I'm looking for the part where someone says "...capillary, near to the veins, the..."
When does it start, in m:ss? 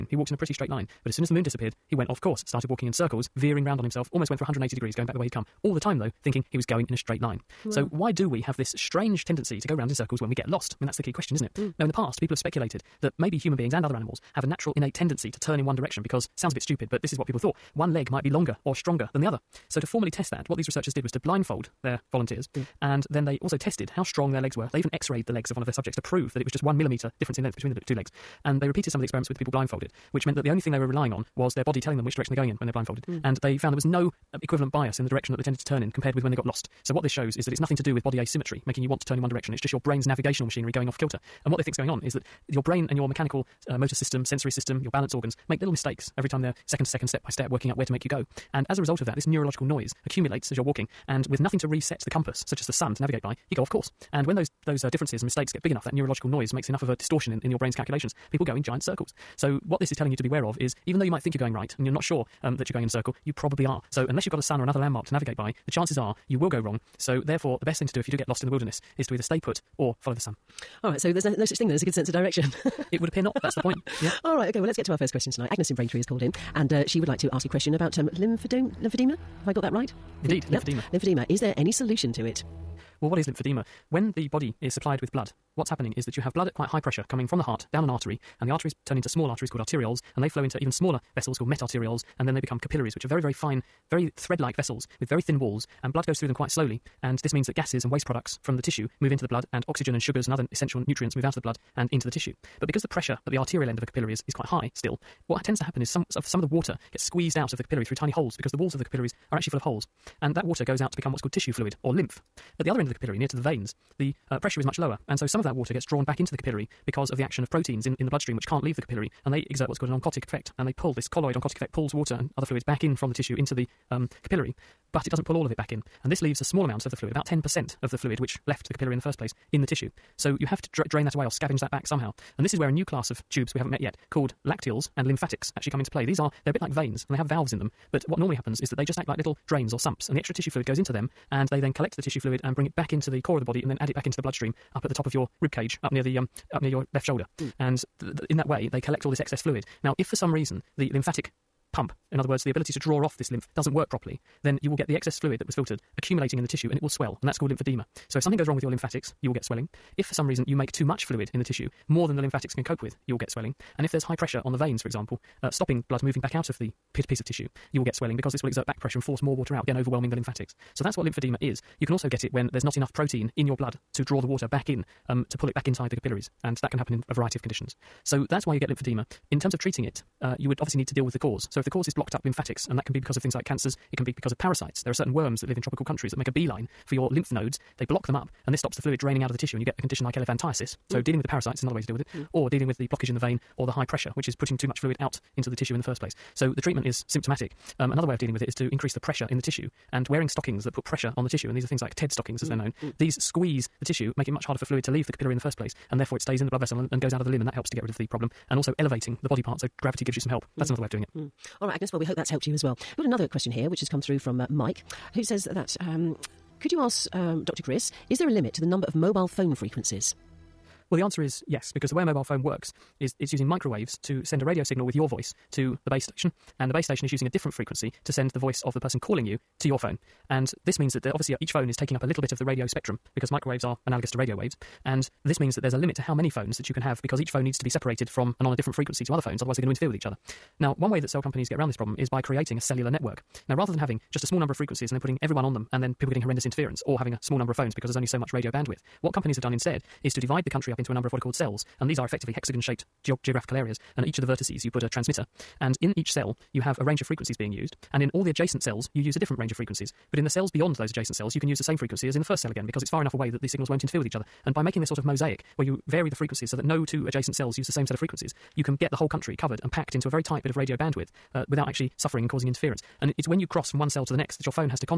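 1:52.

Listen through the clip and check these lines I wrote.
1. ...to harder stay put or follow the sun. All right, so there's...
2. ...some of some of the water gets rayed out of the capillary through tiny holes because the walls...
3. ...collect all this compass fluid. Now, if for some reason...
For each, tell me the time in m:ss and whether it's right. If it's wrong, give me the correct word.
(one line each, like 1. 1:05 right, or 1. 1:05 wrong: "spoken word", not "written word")
1. 1:09 wrong: "either", not "harder"
2. 1:45 wrong: "squeezed", not "rayed"
3. 2:28 wrong: "excess", not "compass".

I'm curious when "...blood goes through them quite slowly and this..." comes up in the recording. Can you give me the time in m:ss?
1:35.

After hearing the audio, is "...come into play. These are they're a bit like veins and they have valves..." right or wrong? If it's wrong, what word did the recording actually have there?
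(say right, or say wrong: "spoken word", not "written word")
right.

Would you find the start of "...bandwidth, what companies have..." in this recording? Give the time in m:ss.
4:08.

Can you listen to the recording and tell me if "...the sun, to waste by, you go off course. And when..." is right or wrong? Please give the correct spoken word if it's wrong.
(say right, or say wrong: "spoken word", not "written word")
wrong: "navigate", not "waste".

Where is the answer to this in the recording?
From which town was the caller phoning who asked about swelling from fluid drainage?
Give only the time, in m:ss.
1:15.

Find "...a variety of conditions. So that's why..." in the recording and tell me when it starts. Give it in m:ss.
2:57.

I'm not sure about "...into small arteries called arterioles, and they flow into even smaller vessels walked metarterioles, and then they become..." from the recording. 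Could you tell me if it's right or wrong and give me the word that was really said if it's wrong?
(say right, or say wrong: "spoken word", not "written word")
wrong: "called", not "walked".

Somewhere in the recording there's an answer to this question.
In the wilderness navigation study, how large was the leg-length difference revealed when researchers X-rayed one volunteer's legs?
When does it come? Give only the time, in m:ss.
0:26.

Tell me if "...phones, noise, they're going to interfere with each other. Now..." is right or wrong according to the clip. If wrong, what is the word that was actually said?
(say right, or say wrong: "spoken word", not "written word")
wrong: "otherwise", not "noise".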